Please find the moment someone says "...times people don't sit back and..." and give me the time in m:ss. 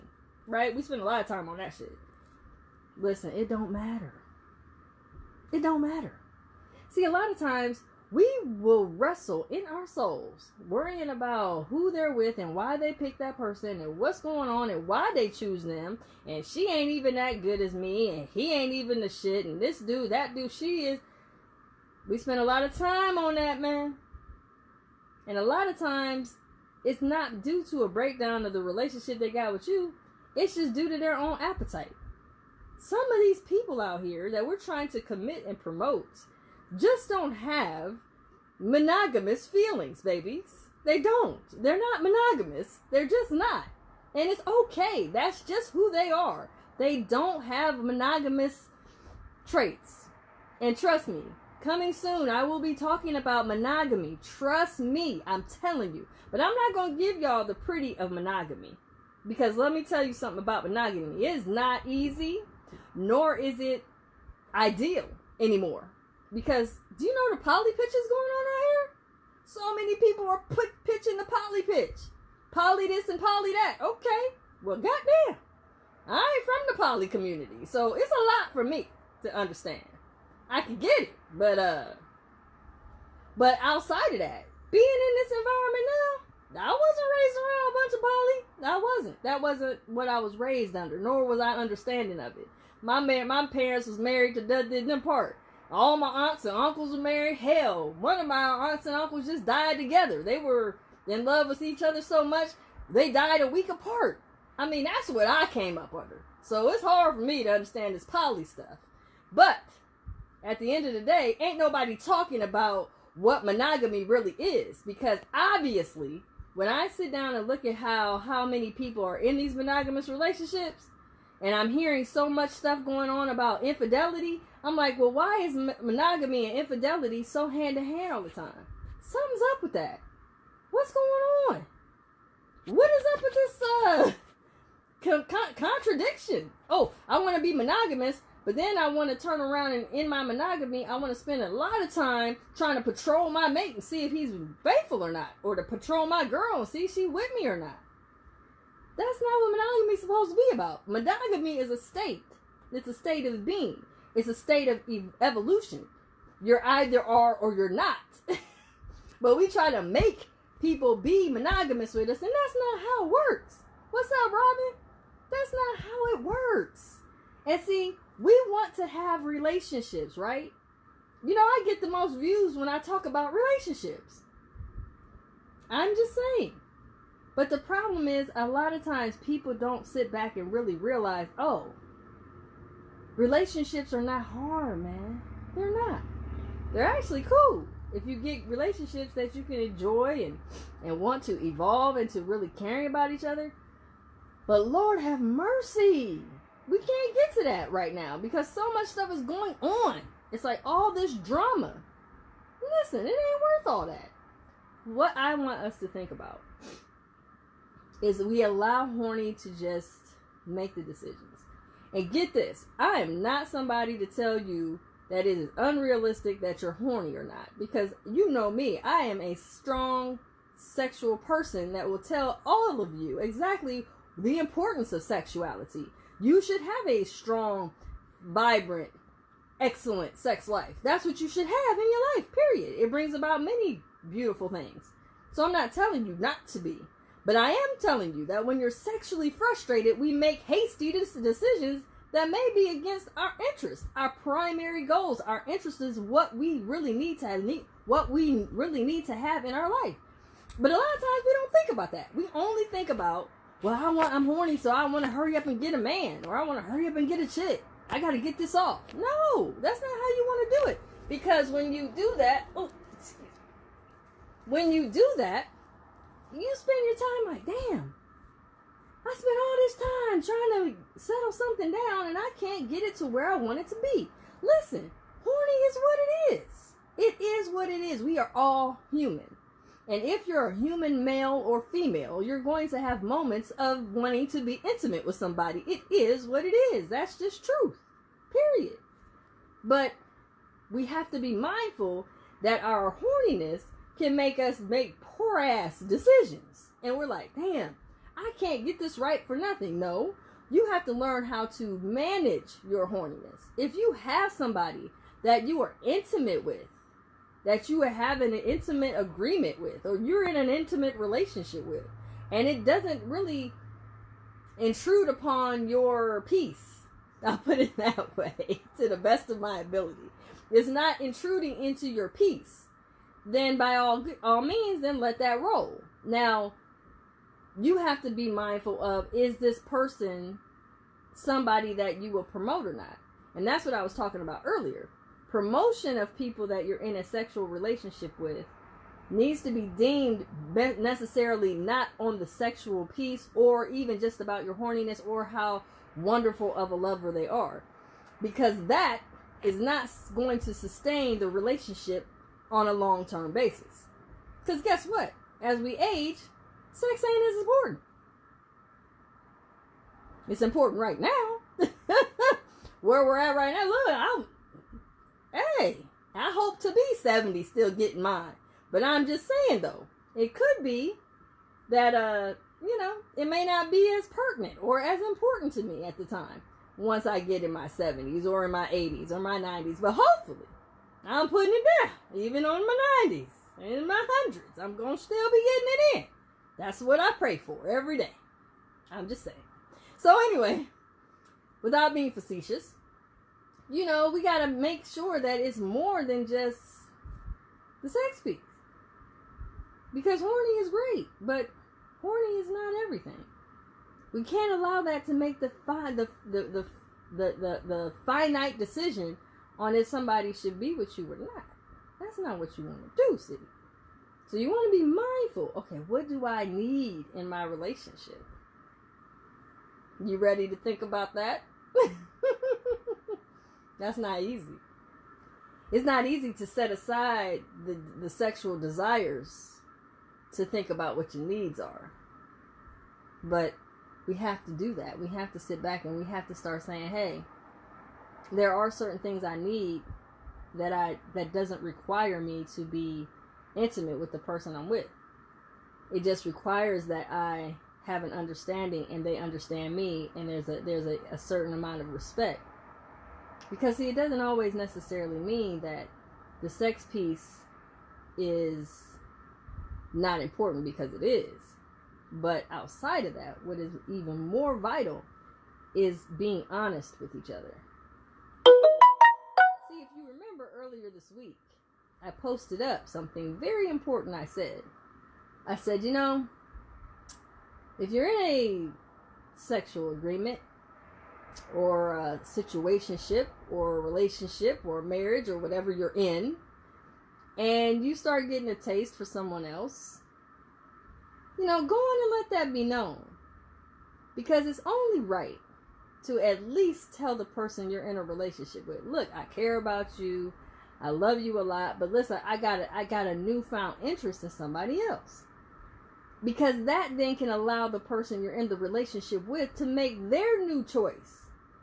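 2:58.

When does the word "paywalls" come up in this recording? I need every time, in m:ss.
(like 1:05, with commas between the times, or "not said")
not said.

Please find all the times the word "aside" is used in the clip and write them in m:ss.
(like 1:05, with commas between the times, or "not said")
7:06.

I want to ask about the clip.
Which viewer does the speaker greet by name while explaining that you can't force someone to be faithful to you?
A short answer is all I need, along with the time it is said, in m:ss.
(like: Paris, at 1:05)
Robin, at 2:44.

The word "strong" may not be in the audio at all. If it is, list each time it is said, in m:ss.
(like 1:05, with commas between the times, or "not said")
3:39, 3:47.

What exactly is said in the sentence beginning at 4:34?
Listen, horny is what it is.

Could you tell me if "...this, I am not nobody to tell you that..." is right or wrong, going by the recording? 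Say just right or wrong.
wrong.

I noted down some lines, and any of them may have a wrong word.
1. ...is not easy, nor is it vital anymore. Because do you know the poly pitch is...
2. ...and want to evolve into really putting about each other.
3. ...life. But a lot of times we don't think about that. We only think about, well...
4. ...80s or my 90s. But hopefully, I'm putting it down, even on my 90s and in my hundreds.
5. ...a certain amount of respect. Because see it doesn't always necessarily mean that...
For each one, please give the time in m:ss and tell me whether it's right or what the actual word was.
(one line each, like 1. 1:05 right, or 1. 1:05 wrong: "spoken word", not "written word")
1. 1:01 wrong: "ideal", not "vital"
2. 3:10 wrong: "caring", not "putting"
3. 4:09 right
4. 6:18 right
5. 7:31 right.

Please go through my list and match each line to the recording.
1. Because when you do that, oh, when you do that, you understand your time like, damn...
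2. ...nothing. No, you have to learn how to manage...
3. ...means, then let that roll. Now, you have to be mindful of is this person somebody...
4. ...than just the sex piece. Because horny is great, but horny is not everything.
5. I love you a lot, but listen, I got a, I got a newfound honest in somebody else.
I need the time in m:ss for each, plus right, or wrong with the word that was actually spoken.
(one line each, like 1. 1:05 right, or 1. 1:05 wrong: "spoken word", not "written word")
1. 4:21 wrong: "spend", not "understand"
2. 4:59 right
3. 5:24 right
4. 6:36 right
5. 8:20 wrong: "interest", not "honest".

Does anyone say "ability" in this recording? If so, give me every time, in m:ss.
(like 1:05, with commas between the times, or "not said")
5:19.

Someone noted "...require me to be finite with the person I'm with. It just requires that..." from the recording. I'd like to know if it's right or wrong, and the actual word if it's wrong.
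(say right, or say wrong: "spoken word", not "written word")
wrong: "intimate", not "finite".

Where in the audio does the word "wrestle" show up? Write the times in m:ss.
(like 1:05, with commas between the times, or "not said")
0:08.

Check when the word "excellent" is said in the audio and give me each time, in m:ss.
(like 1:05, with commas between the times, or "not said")
3:49.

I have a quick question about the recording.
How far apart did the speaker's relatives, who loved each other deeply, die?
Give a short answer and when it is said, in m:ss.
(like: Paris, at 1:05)
a week apart, at 1:43.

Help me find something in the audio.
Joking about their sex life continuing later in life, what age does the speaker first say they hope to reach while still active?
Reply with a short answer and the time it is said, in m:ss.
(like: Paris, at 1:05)
70, at 6:06.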